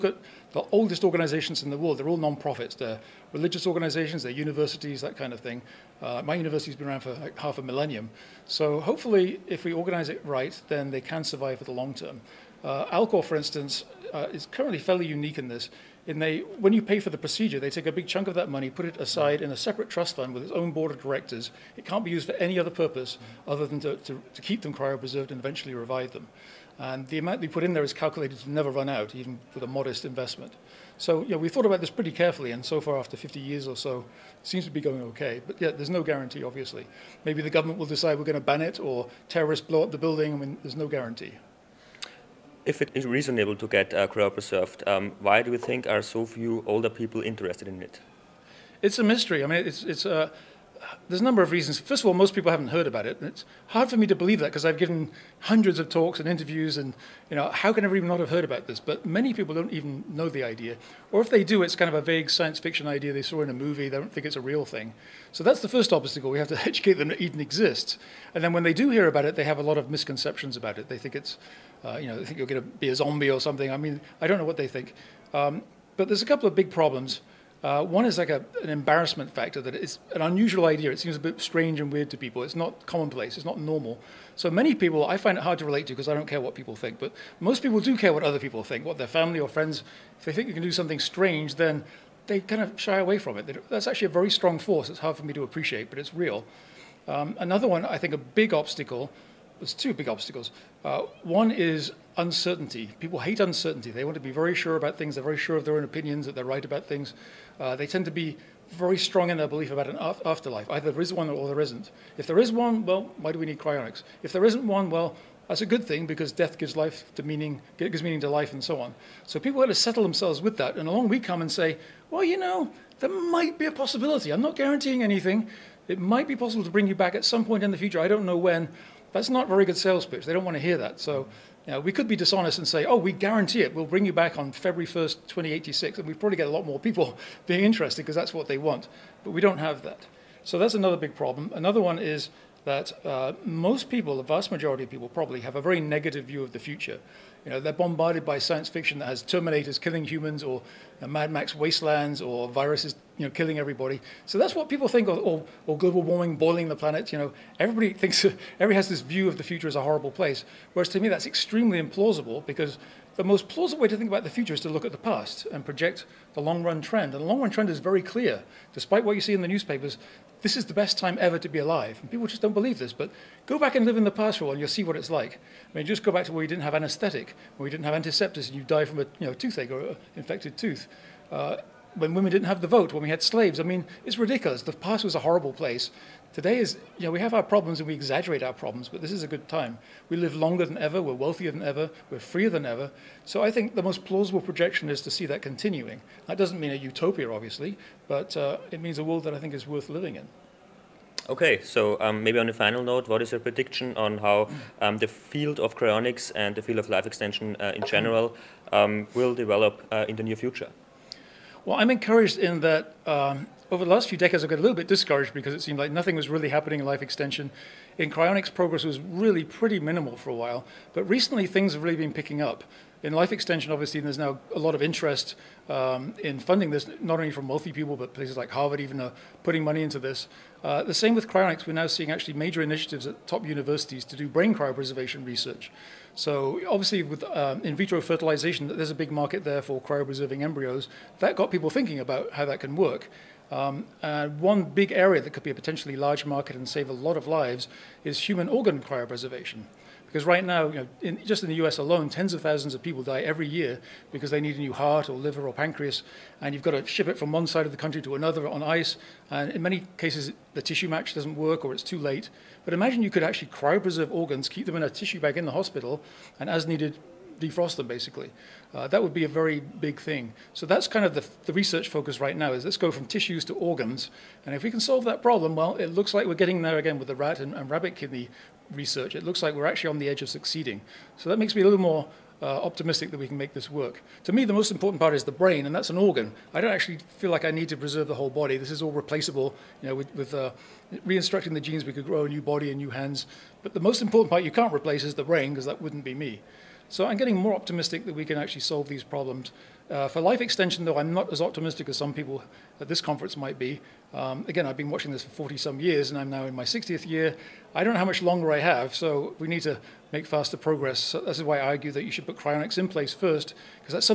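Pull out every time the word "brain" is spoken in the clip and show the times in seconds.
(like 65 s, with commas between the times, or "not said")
234 s, 285 s, 295 s.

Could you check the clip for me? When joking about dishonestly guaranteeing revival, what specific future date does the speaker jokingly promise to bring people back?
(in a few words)
February 1st, 2086.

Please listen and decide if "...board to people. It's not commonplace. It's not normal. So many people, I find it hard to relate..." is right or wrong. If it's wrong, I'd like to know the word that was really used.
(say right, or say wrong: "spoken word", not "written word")
wrong: "weird", not "board".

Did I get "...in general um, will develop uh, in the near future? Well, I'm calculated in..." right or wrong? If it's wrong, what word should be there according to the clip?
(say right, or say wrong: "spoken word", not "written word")
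wrong: "encouraged", not "calculated".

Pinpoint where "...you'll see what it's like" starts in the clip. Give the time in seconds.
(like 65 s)
174 s.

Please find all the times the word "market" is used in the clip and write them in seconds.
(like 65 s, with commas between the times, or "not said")
239 s, 246 s.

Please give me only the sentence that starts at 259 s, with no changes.
And in many cases, the tissue match doesn't work or it's too late.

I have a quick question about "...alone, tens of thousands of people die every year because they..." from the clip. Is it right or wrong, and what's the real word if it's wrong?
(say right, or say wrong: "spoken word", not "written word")
right.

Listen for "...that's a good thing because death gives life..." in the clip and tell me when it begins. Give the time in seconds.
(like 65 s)
115 s.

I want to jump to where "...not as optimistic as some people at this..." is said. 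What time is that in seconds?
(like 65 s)
301 s.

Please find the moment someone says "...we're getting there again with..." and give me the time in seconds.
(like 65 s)
276 s.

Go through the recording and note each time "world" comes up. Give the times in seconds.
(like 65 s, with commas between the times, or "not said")
1 s, 199 s.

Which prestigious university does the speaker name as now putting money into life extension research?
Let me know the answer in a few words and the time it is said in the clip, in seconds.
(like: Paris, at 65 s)
Harvard, at 228 s.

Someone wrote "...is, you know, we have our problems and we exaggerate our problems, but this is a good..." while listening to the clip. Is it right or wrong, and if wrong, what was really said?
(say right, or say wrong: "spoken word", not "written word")
right.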